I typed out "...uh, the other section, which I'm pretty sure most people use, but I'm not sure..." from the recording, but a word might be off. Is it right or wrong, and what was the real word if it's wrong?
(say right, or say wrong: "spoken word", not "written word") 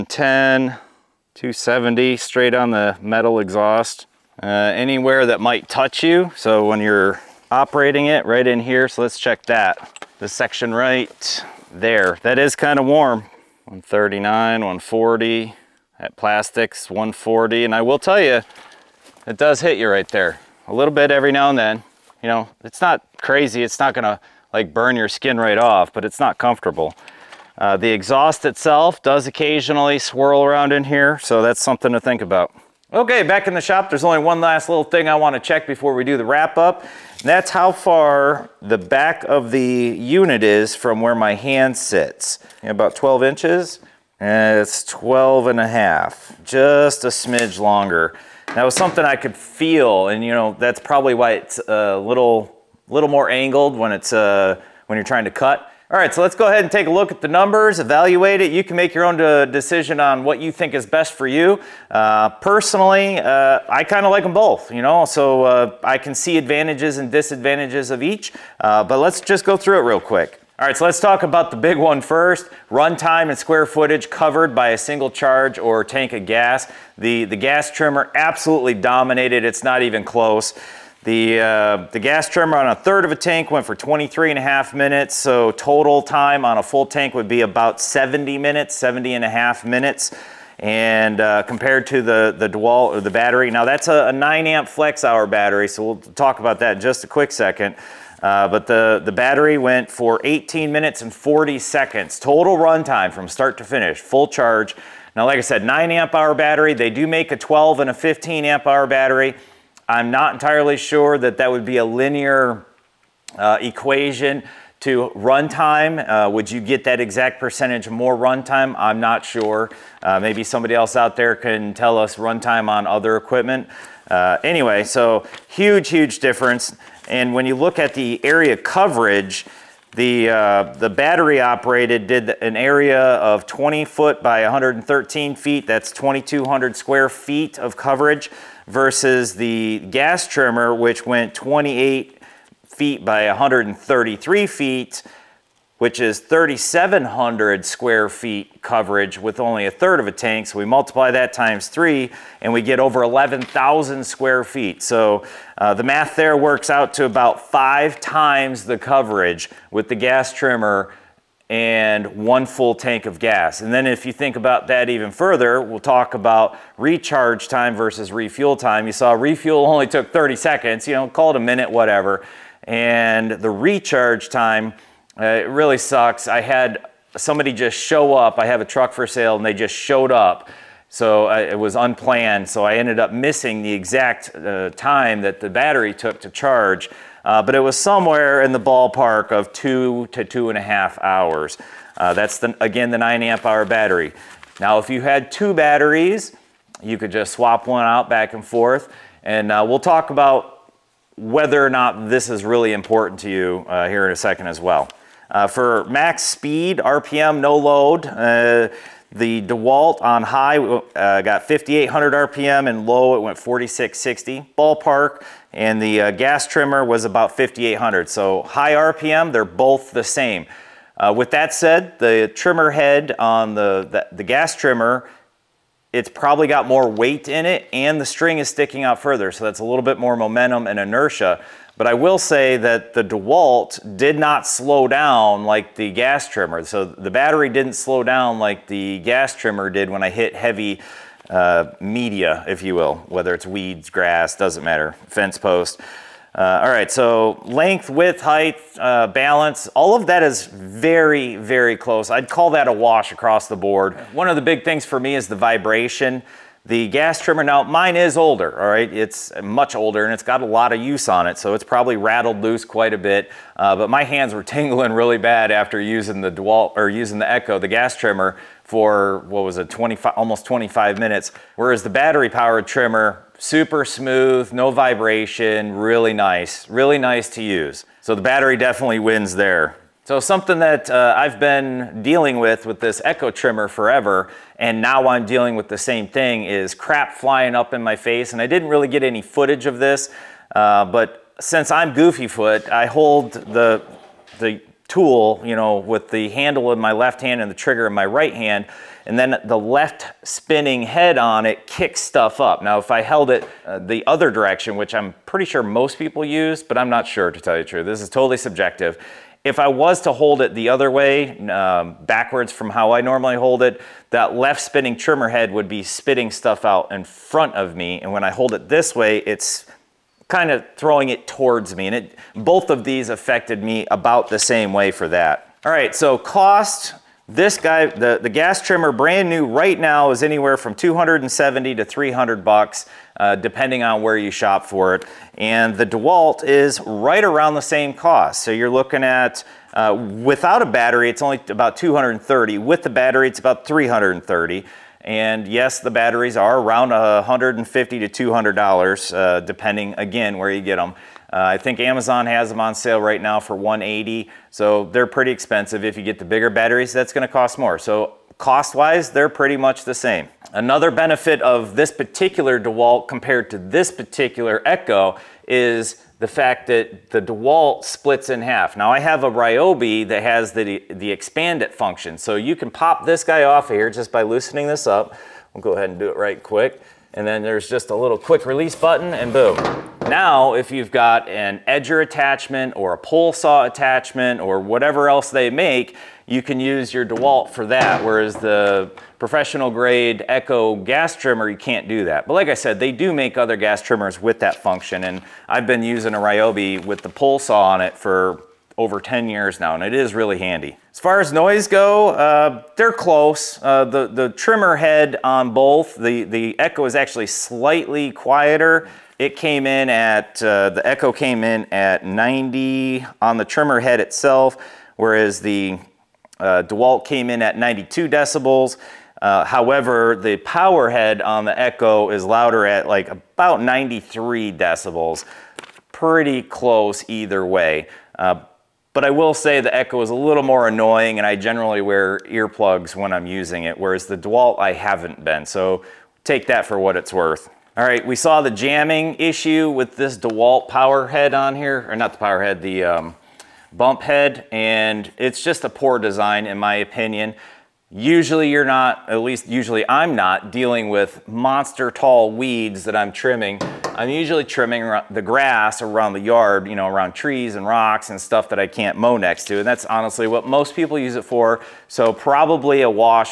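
wrong: "direction", not "section".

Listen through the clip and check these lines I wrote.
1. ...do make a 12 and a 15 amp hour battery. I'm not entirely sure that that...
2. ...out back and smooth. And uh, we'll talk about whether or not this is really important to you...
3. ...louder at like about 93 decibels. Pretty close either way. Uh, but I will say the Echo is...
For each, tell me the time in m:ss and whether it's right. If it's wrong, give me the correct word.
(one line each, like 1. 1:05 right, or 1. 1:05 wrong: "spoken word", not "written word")
1. 1:46 right
2. 3:17 wrong: "forth", not "smooth"
3. 7:02 right.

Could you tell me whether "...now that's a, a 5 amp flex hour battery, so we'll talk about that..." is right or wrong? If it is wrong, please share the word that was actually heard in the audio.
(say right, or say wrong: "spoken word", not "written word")
wrong: "9", not "5".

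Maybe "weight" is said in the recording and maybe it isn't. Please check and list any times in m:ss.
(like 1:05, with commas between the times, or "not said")
3:46.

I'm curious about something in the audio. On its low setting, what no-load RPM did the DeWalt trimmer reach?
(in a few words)
4660.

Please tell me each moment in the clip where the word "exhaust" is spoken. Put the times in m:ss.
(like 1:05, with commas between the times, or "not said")
0:03, 0:27.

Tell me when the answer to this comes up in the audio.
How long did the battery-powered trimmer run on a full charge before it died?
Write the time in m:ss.
1:40.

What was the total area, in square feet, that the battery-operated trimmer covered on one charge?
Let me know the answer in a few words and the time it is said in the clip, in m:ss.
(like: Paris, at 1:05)
2,200 square feet, at 2:15.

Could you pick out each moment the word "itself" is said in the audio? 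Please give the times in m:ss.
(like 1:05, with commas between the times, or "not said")
0:28, 6:53.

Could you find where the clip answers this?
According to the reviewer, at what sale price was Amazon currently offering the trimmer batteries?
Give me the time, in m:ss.
5:53.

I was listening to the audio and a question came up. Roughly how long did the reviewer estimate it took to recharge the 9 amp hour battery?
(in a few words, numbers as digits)
2 to 2.5 hours.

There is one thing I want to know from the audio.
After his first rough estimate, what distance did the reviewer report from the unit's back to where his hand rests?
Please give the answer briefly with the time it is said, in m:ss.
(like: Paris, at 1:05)
12 and a half inches, at 0:44.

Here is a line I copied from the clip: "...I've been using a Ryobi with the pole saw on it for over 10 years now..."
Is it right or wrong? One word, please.
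right.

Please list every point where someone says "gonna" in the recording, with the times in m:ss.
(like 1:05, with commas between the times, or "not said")
0:23, 5:57.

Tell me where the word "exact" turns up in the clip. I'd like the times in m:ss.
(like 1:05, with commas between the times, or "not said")
1:57, 3:03.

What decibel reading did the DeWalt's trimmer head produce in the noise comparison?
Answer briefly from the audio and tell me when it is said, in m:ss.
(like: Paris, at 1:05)
92 decibels, at 6:57.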